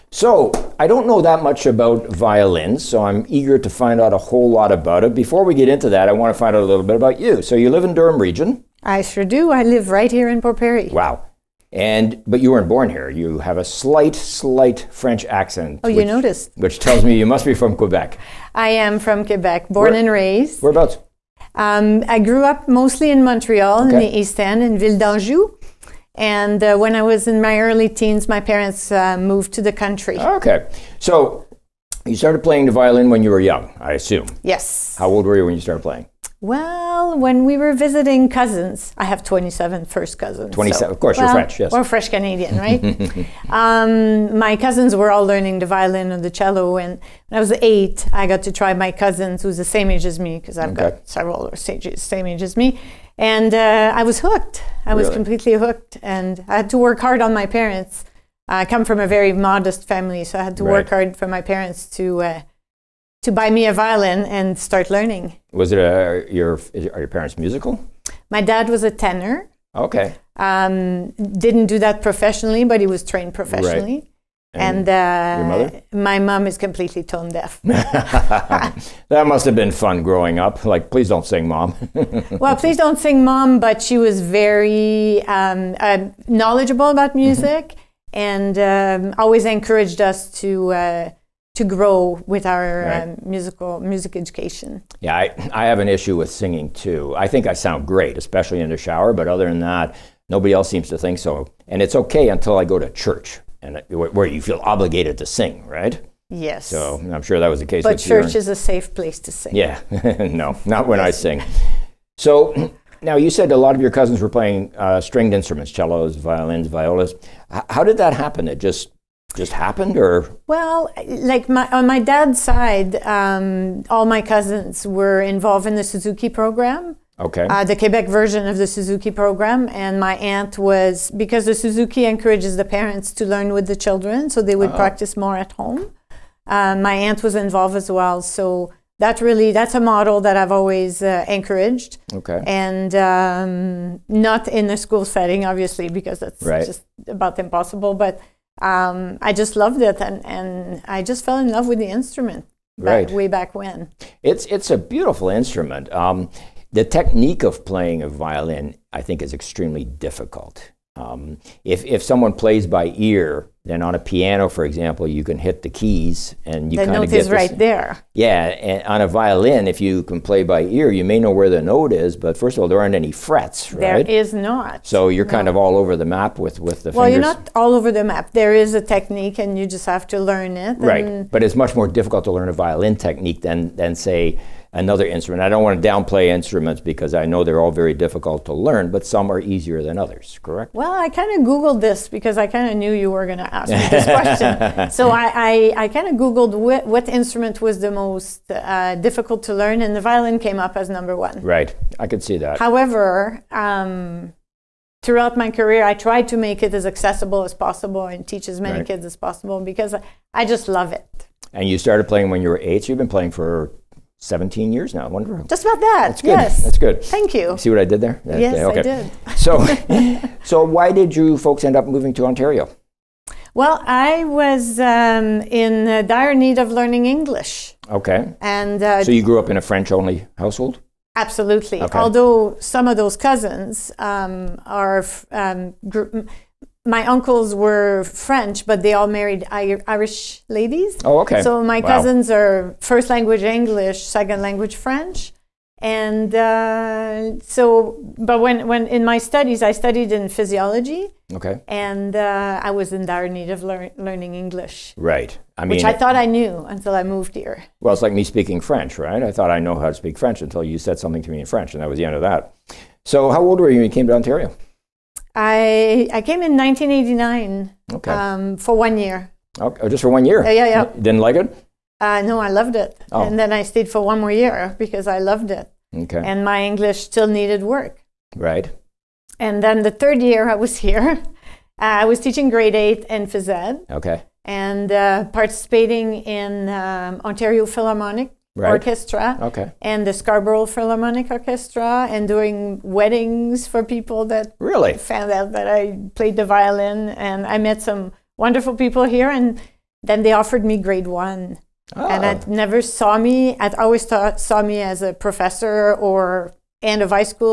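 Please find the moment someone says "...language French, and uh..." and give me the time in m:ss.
4:04.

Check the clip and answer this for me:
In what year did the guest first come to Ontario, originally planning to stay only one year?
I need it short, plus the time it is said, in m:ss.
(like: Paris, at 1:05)
1989, at 4:26.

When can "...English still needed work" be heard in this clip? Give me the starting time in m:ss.
4:36.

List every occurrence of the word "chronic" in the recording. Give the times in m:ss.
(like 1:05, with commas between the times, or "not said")
not said.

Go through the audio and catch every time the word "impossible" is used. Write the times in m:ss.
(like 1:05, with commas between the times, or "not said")
2:27.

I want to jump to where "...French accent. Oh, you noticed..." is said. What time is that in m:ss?
0:14.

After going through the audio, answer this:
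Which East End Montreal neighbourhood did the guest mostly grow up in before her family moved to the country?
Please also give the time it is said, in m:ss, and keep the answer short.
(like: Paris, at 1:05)
Ville d'Anjou, at 0:24.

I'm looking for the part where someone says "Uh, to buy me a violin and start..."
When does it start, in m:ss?
1:02.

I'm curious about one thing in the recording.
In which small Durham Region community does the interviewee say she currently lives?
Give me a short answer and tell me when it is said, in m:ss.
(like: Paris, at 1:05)
Port Perry, at 0:10.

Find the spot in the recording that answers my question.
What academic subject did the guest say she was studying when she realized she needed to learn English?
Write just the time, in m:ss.
4:10.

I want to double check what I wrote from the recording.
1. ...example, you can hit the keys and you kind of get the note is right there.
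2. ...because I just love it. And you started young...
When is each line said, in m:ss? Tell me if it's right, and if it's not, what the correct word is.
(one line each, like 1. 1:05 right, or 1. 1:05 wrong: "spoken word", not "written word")
1. 2:44 right
2. 3:29 wrong: "playing", not "young".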